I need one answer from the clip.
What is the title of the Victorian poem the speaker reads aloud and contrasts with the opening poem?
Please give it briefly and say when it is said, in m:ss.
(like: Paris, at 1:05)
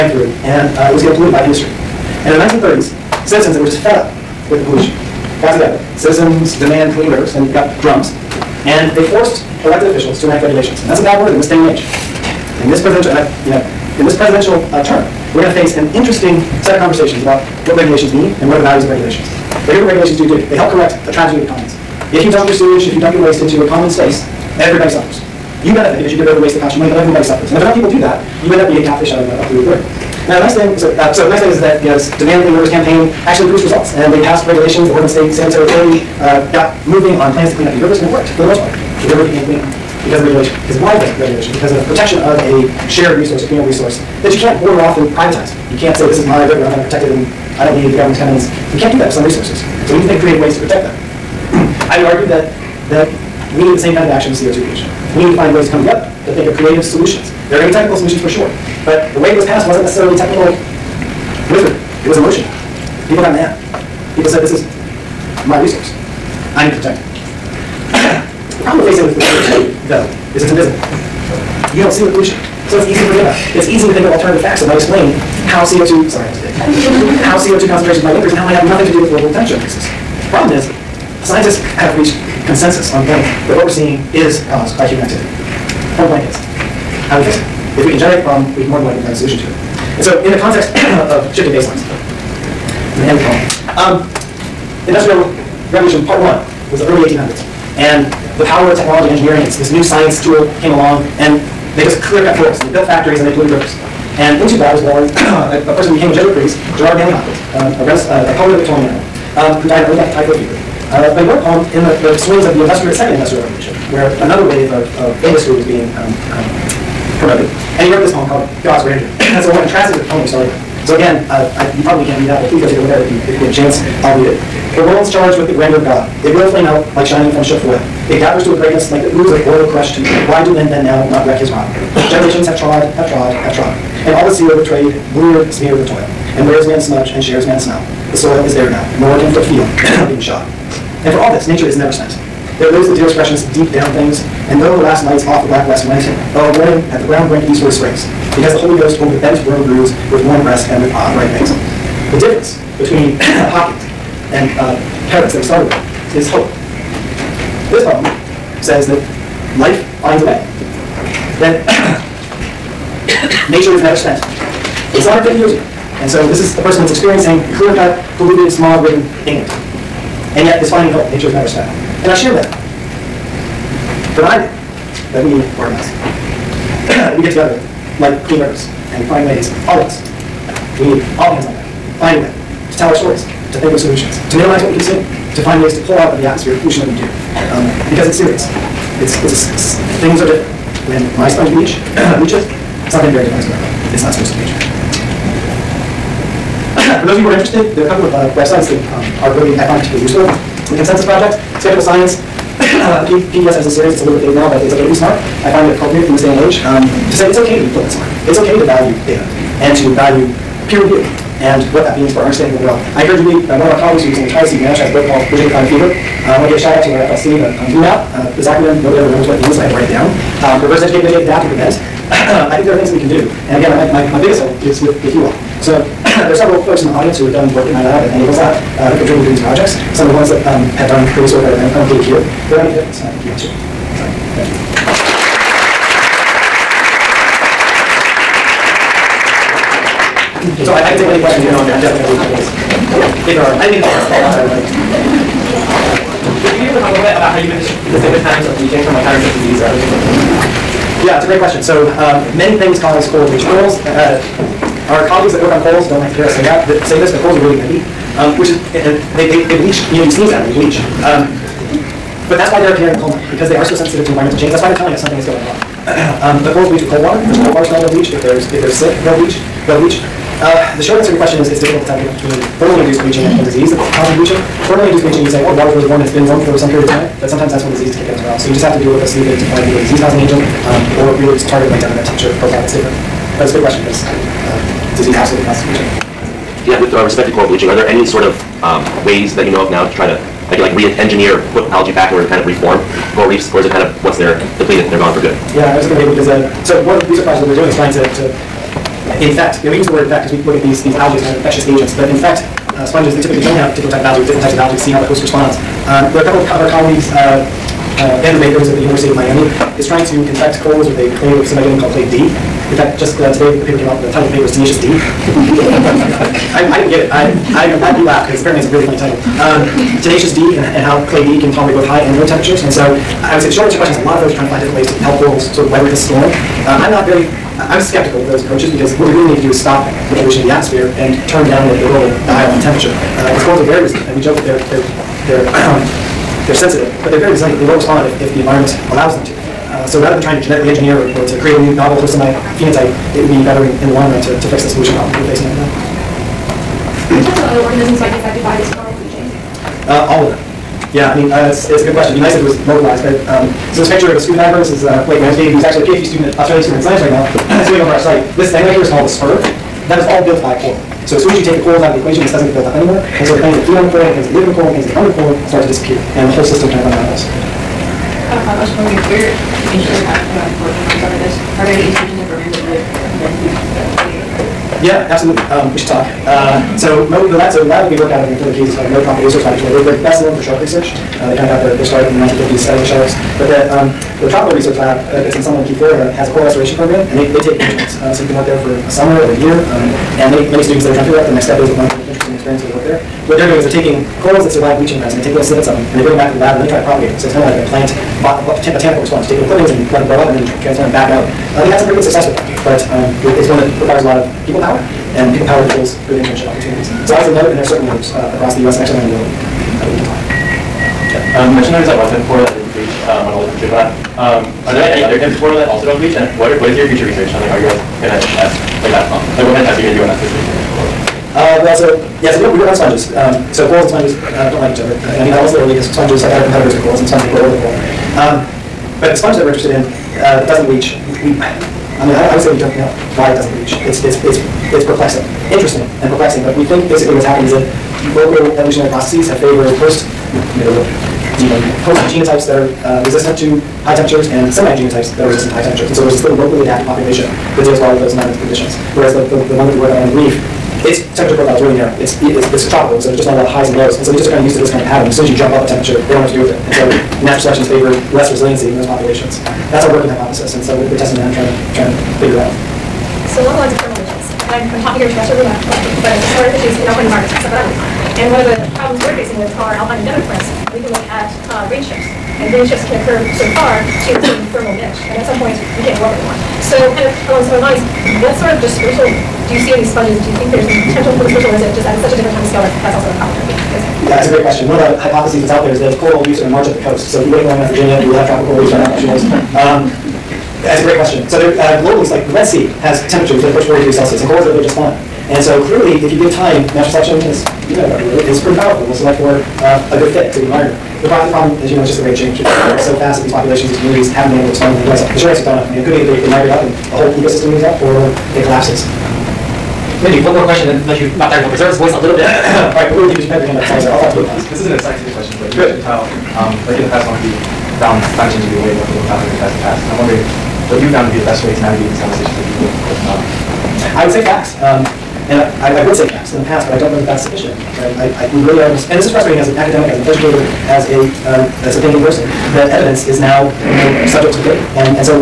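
God's Grandeur, at 1:58.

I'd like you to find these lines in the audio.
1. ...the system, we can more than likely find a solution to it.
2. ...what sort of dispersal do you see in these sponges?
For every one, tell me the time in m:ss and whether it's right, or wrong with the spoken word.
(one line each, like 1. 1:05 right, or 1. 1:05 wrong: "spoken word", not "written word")
1. 1:28 wrong: "problem", not "system"
2. 7:58 right.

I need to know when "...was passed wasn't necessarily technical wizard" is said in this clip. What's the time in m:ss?
0:59.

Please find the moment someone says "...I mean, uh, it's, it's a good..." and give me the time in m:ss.
5:51.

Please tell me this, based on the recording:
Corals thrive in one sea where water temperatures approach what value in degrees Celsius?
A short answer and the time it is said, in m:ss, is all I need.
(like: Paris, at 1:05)
40, at 8:13.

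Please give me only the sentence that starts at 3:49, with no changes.
Some of the ones that um, have done previous work are included here.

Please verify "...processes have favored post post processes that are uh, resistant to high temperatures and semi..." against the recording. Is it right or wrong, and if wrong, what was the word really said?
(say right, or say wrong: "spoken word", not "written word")
wrong: "genotypes", not "processes".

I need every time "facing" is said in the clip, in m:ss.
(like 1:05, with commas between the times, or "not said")
1:08, 5:45, 7:49.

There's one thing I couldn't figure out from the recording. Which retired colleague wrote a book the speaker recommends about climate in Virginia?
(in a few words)
Steve Nash.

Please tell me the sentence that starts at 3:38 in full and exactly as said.
Uh, the this acronym, nobody ever remembers what it means, so I had to write it down.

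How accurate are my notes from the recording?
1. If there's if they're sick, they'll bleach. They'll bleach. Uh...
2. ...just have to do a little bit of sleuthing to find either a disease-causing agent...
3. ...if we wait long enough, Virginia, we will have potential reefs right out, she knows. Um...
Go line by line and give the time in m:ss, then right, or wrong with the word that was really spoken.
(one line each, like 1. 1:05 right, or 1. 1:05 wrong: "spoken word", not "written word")
1. 4:28 right
2. 4:38 right
3. 8:07 wrong: "tropical", not "potential".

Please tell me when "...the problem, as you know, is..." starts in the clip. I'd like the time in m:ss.
8:21.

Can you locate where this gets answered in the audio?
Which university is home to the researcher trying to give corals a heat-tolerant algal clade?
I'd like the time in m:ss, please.
5:08.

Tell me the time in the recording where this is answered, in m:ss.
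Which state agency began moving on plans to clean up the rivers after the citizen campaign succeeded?
0:34.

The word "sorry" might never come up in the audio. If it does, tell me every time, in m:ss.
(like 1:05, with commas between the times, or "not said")
1:16, 8:33.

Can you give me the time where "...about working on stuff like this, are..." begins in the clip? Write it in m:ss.
6:10.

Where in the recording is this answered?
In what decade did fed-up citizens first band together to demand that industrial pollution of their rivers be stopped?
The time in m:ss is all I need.
0:02.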